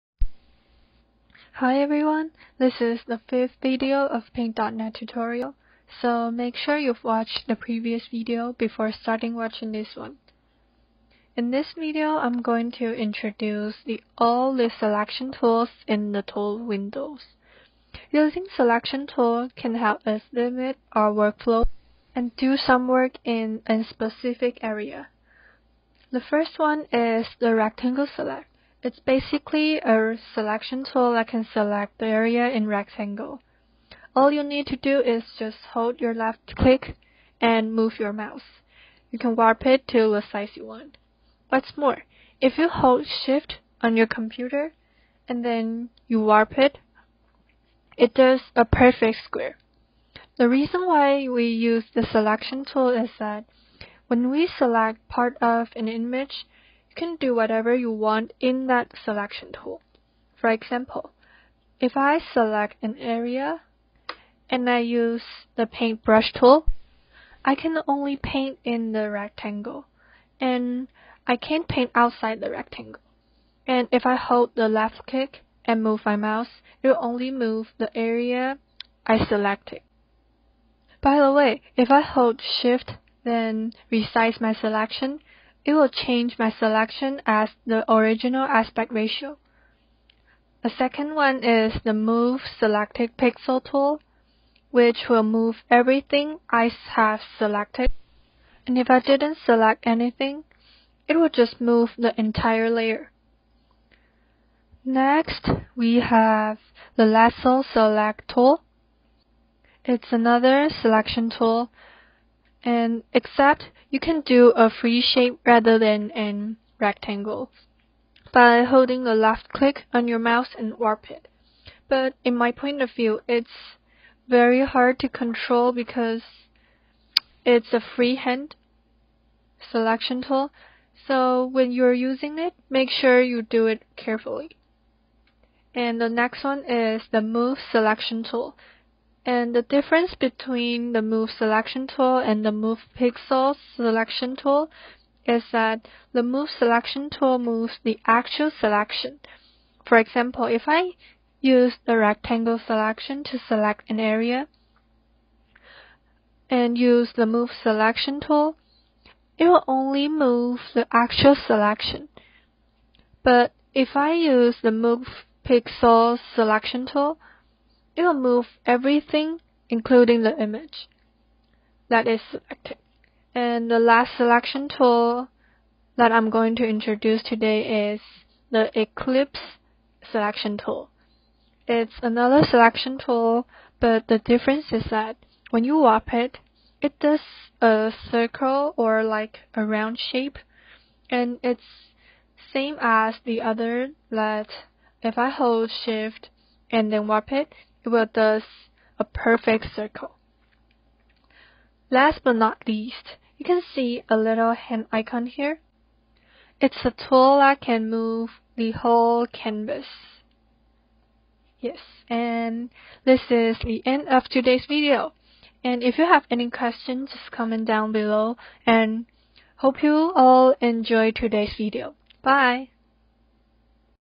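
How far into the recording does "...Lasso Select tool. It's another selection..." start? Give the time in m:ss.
1:47.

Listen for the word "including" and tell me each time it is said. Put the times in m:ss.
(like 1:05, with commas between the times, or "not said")
2:49.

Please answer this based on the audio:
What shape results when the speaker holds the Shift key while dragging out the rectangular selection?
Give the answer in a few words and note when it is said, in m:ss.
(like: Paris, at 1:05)
Perfect square, at 0:48.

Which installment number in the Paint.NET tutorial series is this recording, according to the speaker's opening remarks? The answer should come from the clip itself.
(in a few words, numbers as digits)
5th.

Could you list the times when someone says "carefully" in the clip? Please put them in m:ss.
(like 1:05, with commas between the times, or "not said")
2:13.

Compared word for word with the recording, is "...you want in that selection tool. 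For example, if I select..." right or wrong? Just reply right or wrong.
right.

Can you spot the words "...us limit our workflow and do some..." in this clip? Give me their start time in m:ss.
0:20.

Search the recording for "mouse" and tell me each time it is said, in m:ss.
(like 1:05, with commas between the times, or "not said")
0:38, 1:16, 2:00.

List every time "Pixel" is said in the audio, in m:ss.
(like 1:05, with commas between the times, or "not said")
1:33, 2:22, 2:45.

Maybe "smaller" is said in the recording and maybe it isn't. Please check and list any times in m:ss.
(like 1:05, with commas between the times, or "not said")
not said.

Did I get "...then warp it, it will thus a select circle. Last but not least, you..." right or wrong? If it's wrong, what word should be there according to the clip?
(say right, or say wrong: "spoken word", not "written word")
wrong: "perfect", not "select".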